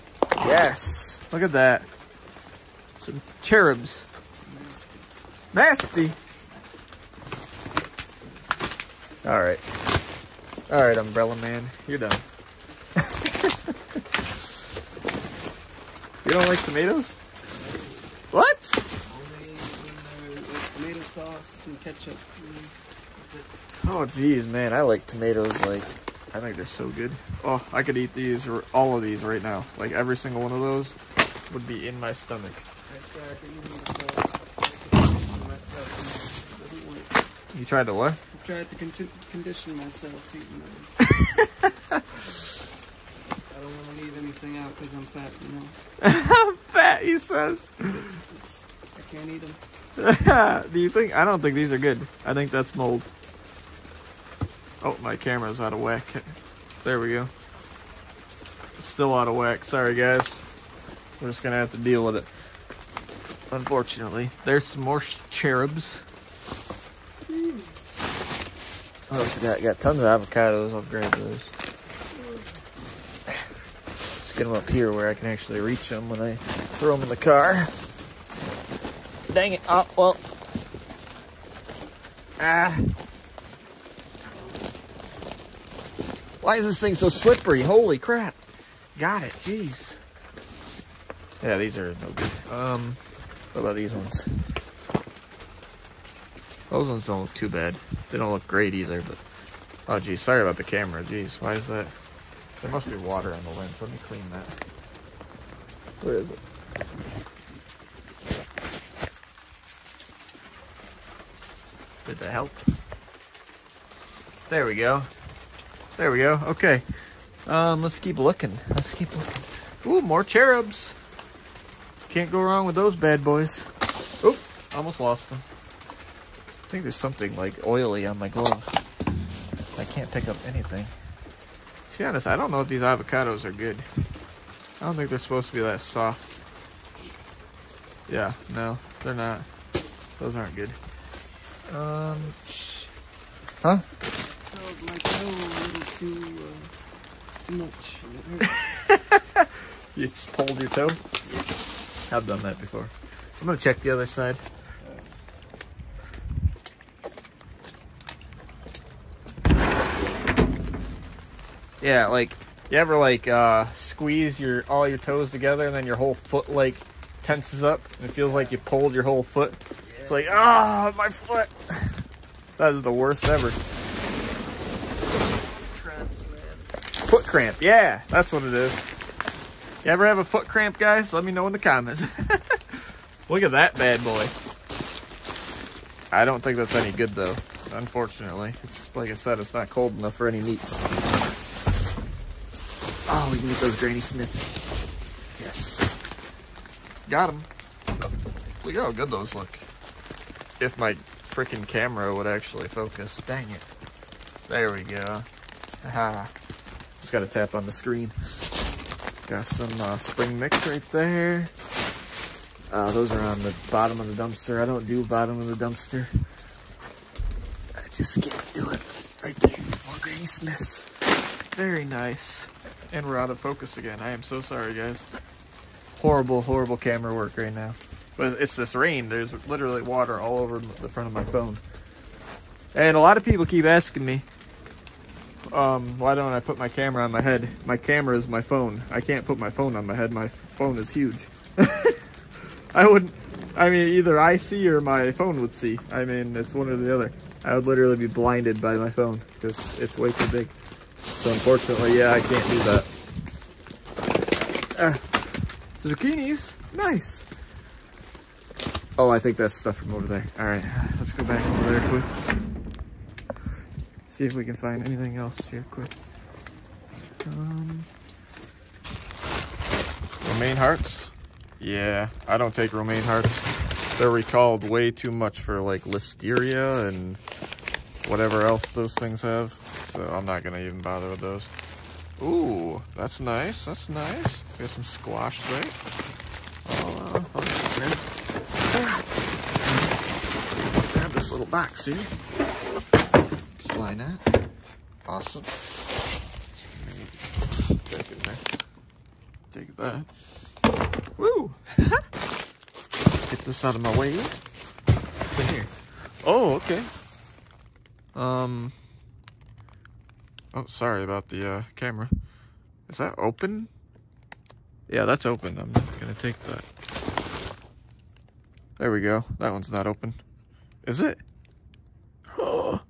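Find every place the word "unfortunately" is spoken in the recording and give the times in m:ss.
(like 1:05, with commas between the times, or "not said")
1:03, 3:07, 4:11.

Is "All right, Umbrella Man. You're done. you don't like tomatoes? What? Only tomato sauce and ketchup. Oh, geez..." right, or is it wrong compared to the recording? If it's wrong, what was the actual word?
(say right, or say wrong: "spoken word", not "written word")
right.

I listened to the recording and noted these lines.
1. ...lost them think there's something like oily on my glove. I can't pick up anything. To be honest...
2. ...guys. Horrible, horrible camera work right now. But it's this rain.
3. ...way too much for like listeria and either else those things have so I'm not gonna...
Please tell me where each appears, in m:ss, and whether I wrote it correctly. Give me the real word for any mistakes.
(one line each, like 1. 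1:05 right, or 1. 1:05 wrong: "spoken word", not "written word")
1. 2:05 right
2. 3:44 right
3. 4:34 wrong: "whatever", not "either".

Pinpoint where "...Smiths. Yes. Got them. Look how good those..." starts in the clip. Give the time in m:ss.
3:13.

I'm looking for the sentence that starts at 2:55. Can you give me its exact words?
Cramps, foot cramp, yeah, that's what it is.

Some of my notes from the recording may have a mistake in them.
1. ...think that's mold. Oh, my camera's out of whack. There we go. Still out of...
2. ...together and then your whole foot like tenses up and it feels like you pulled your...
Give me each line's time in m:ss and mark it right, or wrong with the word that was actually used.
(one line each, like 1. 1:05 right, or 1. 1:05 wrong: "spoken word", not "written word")
1. 0:52 right
2. 2:45 right.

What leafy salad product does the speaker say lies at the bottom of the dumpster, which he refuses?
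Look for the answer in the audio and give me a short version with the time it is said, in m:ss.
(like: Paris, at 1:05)
spring mix, at 3:29.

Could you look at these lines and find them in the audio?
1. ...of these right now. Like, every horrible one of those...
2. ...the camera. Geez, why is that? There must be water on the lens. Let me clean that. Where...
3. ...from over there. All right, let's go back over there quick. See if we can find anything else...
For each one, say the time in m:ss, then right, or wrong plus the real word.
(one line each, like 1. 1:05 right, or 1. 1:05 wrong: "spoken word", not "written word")
1. 0:28 wrong: "single", not "horrible"
2. 1:40 right
3. 4:19 right.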